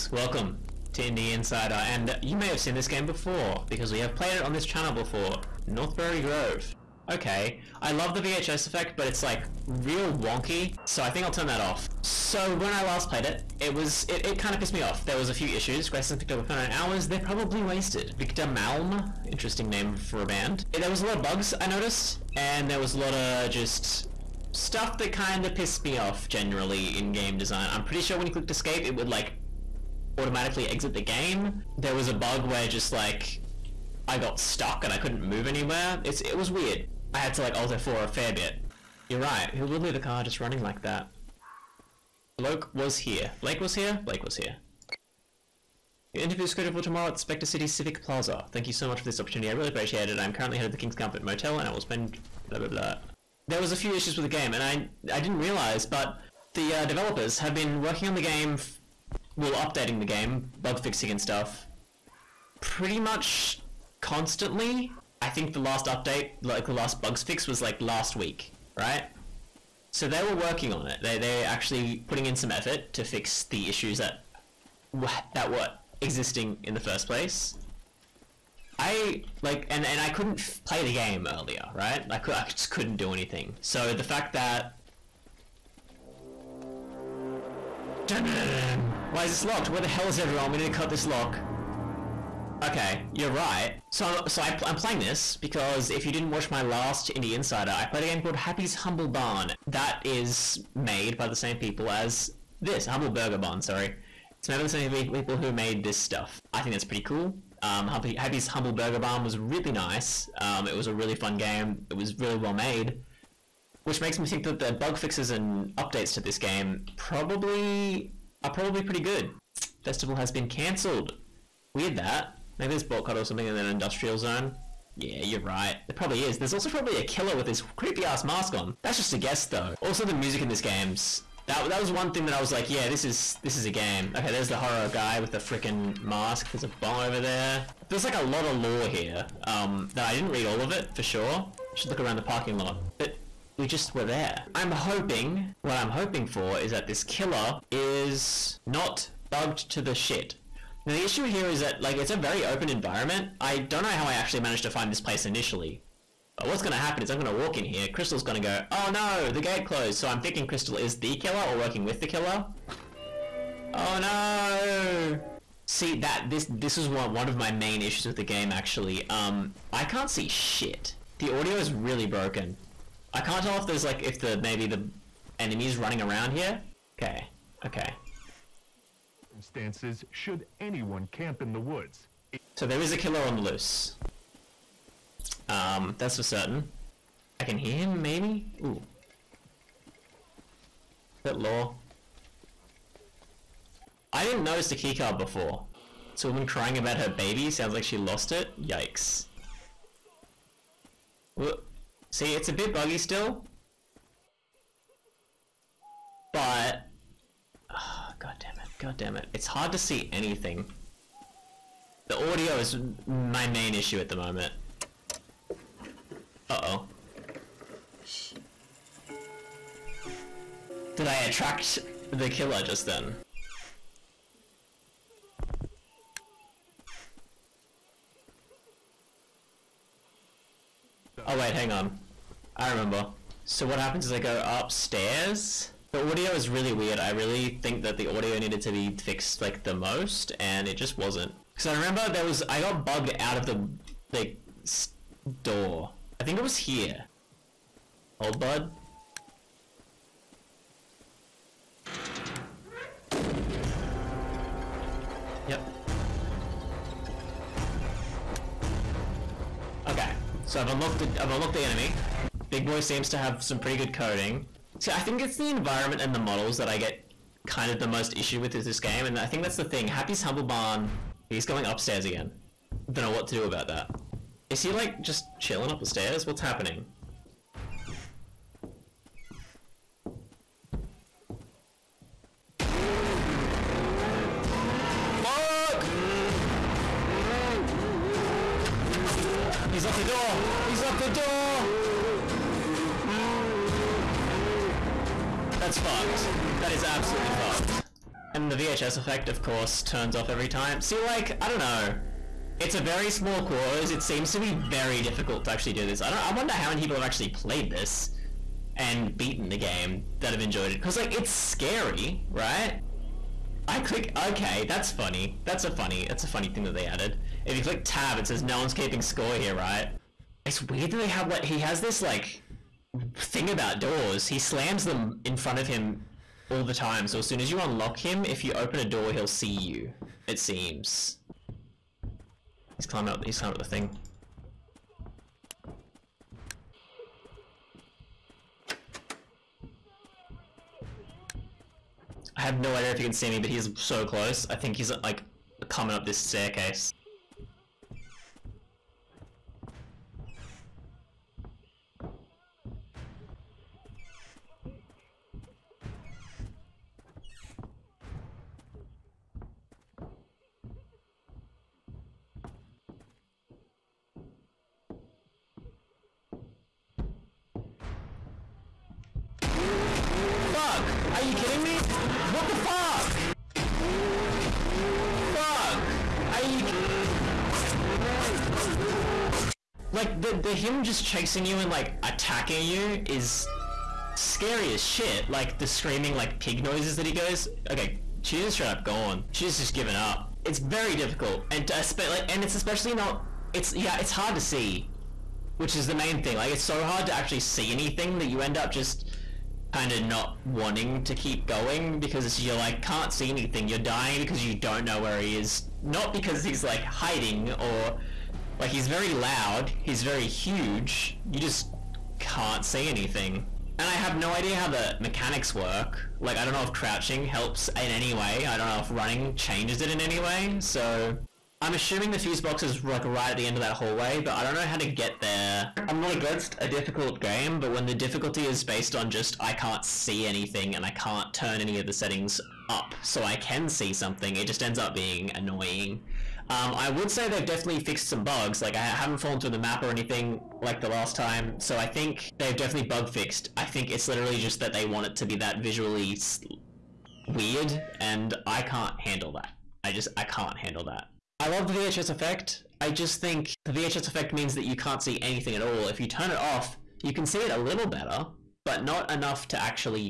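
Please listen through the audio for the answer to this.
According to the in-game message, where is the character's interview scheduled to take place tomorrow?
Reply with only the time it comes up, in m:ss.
0:47.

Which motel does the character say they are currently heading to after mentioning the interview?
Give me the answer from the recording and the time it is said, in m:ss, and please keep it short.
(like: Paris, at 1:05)
King's Comfort Motel, at 0:50.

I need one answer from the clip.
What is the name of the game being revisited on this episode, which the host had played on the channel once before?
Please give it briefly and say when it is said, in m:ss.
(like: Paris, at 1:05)
Northbury Grove, at 0:05.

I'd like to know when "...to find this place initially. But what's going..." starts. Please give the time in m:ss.
2:34.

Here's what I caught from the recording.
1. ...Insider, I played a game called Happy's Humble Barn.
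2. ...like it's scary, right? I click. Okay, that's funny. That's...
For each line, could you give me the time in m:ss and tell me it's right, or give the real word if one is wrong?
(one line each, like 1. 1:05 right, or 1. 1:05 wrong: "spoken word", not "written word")
1. 1:37 right
2. 5:10 right.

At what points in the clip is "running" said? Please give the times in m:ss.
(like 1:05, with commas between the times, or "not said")
0:40, 2:55, 6:58.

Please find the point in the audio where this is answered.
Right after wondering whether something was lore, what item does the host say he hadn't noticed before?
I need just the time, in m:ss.
3:14.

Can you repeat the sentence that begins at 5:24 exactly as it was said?
He slams them in front of him all the time.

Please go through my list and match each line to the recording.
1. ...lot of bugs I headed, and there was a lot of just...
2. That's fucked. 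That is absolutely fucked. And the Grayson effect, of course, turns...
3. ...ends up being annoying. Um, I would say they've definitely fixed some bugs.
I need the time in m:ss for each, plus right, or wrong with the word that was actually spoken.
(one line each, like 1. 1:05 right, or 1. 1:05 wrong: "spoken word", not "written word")
1. 0:21 wrong: "noticed", not "headed"
2. 4:55 wrong: "VHS", not "Grayson"
3. 7:14 right.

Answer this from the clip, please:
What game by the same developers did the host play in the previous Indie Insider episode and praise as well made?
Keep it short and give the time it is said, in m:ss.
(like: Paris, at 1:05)
Happy's Humble Burger Barn, at 1:47.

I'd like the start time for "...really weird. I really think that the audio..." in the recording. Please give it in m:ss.
3:56.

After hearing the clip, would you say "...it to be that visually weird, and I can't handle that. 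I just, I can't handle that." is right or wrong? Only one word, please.
right.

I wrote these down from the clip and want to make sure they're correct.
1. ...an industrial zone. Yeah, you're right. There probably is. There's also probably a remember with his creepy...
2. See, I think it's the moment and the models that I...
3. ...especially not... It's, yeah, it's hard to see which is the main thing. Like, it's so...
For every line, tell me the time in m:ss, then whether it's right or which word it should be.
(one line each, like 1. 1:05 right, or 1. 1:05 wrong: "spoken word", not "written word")
1. 2:03 wrong: "killer", not "remember"
2. 4:24 wrong: "environment", not "moment"
3. 6:32 right.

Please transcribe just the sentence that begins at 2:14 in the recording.
Okay, there's the horror guy with the freaking mask.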